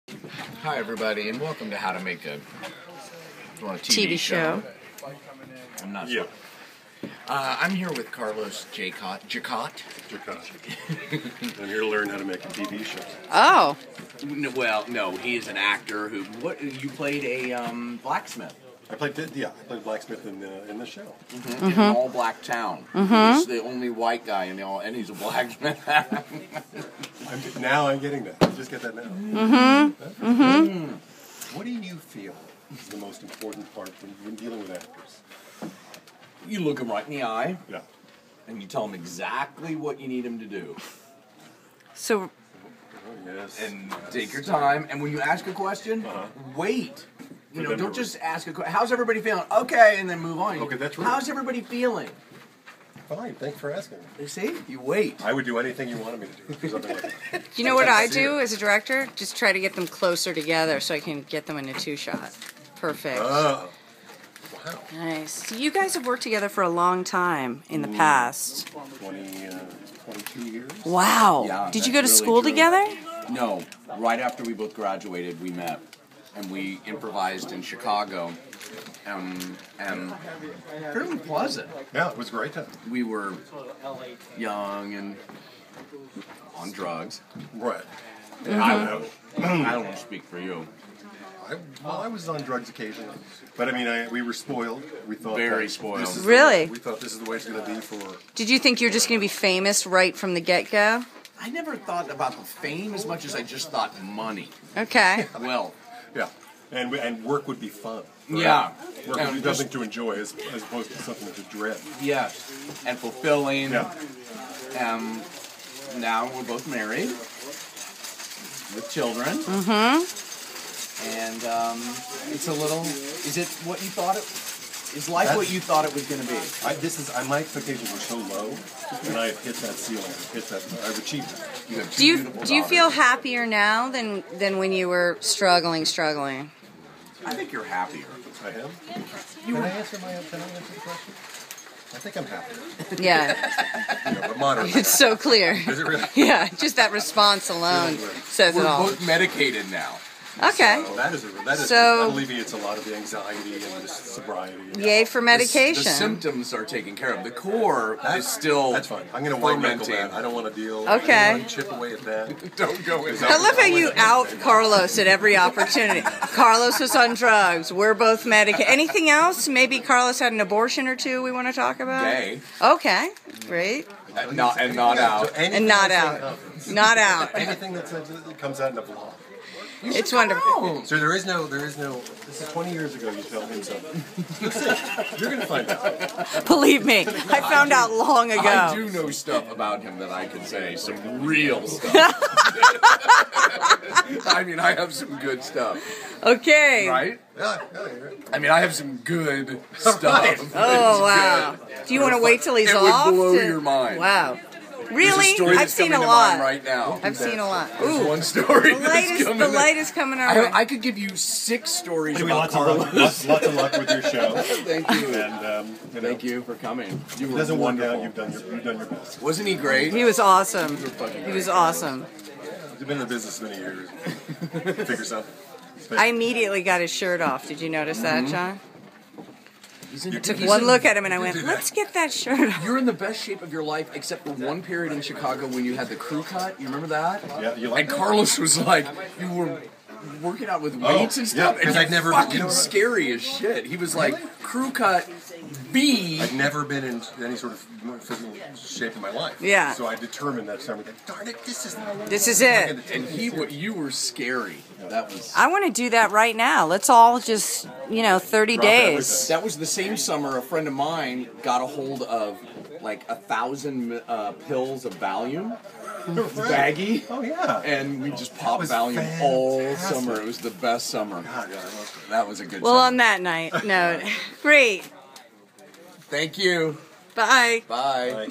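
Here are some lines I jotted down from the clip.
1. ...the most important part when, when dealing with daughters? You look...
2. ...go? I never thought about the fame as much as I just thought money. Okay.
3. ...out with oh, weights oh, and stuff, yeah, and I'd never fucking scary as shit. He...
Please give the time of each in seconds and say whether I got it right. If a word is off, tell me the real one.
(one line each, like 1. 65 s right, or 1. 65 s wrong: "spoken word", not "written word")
1. 32 s wrong: "actors", not "daughters"
2. 100 s right
3. 240 s right.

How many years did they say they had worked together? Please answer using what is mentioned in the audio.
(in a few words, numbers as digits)
22.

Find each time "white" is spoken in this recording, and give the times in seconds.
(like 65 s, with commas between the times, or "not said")
23 s, 159 s.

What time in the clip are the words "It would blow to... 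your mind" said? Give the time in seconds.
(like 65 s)
203 s.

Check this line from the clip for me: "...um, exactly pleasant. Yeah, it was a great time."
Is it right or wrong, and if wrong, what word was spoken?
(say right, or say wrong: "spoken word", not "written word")
wrong: "fairly", not "exactly".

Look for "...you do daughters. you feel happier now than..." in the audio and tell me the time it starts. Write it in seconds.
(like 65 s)
132 s.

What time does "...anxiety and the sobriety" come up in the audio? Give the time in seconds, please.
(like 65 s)
152 s.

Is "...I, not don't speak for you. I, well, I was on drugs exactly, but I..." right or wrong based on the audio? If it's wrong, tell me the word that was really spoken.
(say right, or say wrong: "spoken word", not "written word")
wrong: "occasionally", not "exactly".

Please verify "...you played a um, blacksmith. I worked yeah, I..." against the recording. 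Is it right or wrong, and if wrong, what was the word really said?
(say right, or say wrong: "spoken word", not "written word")
wrong: "played", not "worked".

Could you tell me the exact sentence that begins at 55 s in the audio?
I would do anything you wanted me to do.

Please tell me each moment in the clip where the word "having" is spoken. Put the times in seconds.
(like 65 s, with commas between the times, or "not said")
not said.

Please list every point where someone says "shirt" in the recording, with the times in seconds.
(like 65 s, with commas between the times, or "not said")
226 s, 232 s.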